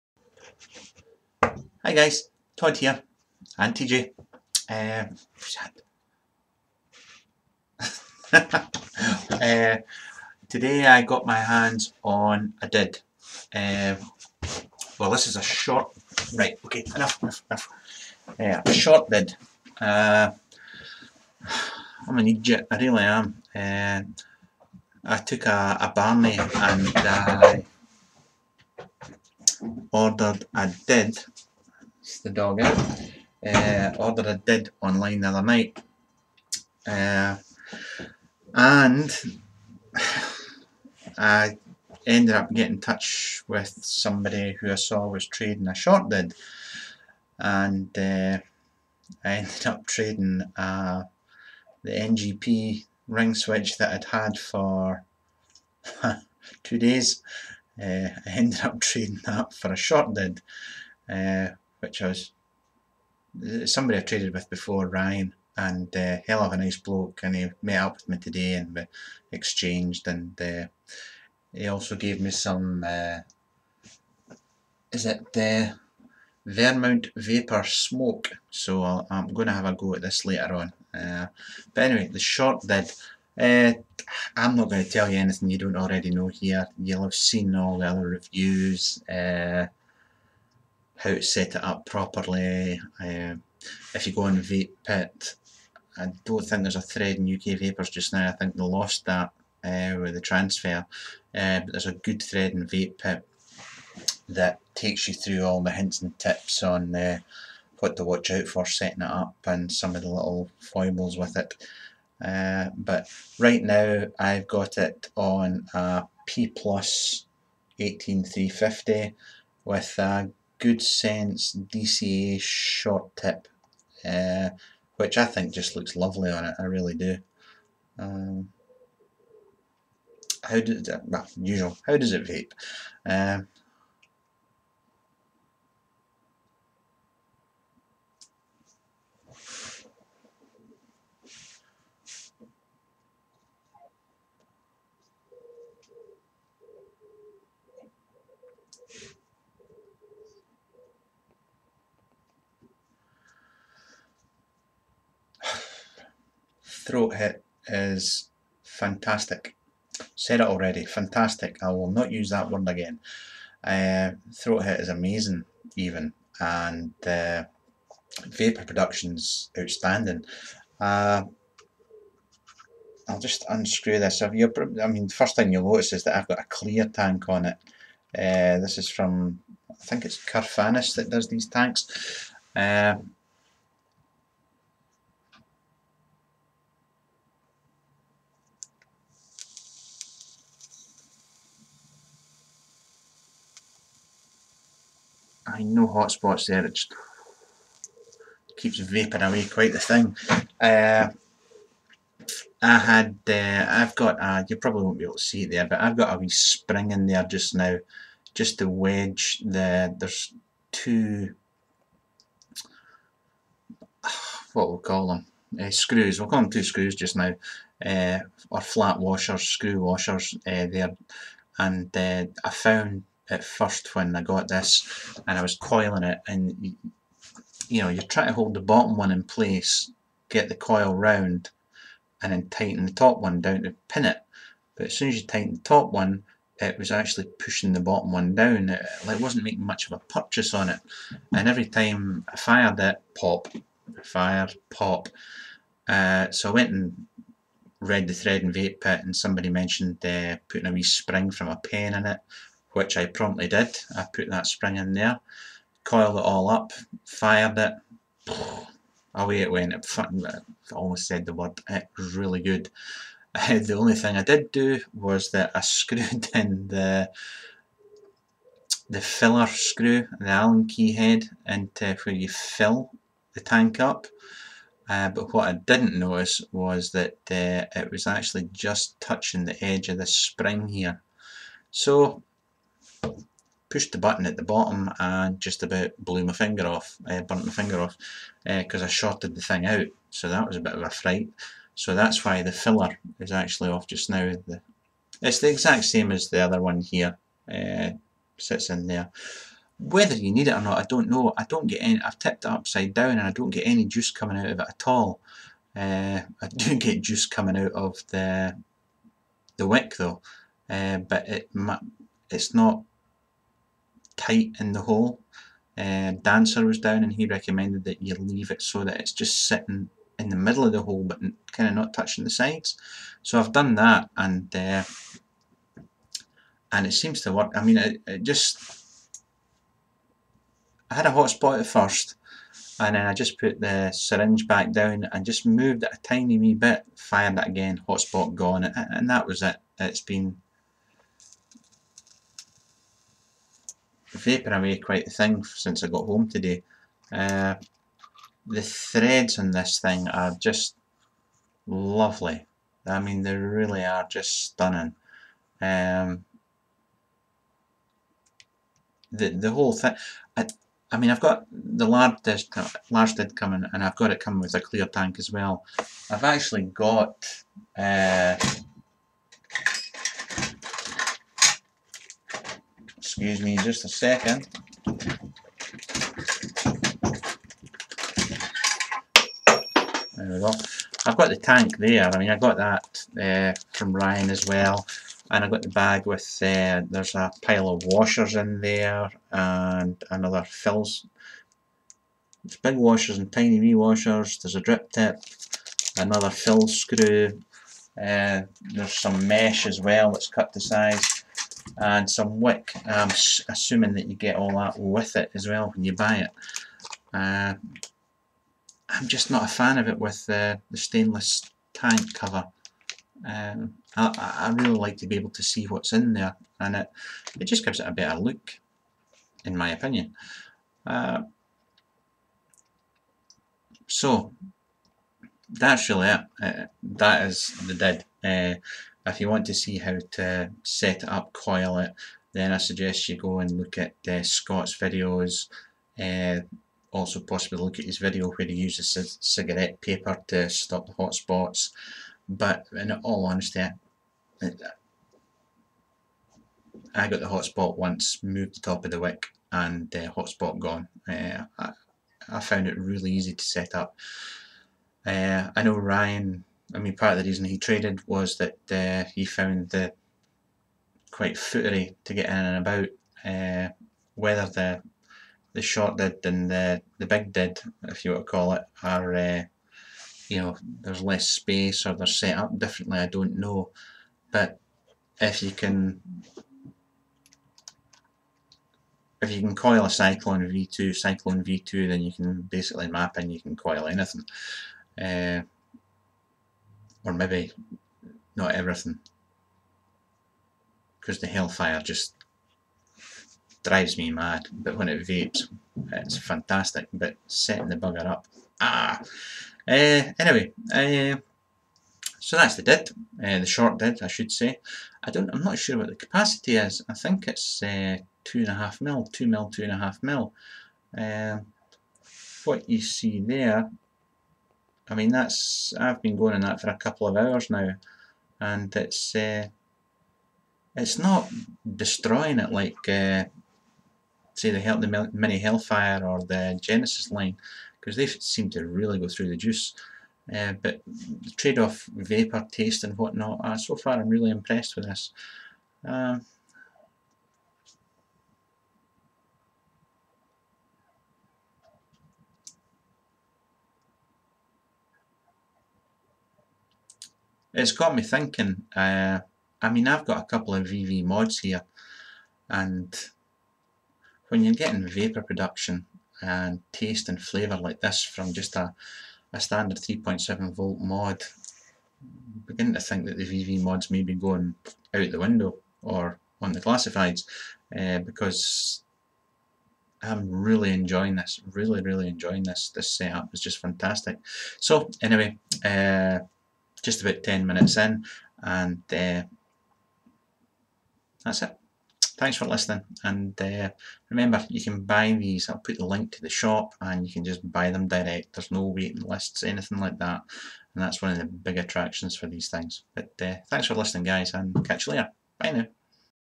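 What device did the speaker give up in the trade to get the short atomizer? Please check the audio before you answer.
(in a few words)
NGP ring switch.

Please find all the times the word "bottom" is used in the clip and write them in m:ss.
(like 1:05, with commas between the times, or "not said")
3:48, 3:57, 4:44.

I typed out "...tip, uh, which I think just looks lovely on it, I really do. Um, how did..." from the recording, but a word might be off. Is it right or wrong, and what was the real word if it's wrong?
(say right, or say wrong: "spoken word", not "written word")
right.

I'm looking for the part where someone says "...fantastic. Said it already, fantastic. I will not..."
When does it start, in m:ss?
2:38.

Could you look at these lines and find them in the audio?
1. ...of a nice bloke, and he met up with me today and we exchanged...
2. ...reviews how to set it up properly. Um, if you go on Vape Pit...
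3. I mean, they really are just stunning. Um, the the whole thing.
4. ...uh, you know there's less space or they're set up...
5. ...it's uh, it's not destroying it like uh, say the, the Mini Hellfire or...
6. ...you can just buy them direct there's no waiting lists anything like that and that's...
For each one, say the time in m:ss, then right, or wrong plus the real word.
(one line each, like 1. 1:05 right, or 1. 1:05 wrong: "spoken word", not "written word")
1. 1:06 right
2. 1:28 right
3. 5:52 right
4. 7:49 right
5. 8:38 right
6. 9:47 right.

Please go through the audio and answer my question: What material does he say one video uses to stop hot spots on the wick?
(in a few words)
cigarette paper.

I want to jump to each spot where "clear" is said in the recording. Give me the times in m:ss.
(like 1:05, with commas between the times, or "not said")
2:56, 6:04.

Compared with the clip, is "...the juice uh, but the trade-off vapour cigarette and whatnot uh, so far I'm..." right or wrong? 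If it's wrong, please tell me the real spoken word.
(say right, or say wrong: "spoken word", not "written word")
wrong: "taste", not "cigarette".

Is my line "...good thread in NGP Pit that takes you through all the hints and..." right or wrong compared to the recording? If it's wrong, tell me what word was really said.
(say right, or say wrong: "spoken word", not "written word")
wrong: "Vape", not "NGP".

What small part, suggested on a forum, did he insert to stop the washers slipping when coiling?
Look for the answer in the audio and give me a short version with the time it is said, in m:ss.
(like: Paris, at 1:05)
spring from a pen, at 4:10.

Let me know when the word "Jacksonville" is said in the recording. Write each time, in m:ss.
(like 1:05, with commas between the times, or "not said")
not said.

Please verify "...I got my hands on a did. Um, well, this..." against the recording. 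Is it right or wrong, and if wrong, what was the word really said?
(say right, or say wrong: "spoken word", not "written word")
right.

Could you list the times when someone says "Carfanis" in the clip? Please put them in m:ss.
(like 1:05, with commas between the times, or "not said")
3:00.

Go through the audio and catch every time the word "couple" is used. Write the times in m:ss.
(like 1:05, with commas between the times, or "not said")
8:36, 9:10.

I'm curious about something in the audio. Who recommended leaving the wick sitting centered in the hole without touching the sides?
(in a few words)
Dancer.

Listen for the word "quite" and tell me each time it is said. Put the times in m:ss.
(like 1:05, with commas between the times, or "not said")
3:19, 5:44, 7:41.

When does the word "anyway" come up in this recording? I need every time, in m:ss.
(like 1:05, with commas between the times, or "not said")
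1:21, 8:20, 9:35.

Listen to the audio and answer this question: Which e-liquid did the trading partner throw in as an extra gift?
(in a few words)
Vermont Vapor Smoke.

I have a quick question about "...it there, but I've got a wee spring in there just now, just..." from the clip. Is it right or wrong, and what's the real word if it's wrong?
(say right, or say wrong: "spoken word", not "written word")
right.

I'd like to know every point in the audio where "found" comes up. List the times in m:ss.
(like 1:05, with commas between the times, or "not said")
3:42, 7:32, 7:39.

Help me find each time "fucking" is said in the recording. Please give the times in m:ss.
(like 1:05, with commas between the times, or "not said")
4:19.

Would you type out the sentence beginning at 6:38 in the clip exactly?
Uh, there's some mesh as well that's cut to size and some wick.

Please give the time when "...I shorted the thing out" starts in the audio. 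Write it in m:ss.
4:48.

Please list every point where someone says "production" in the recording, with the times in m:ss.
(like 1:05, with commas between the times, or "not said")
2:48, 9:15.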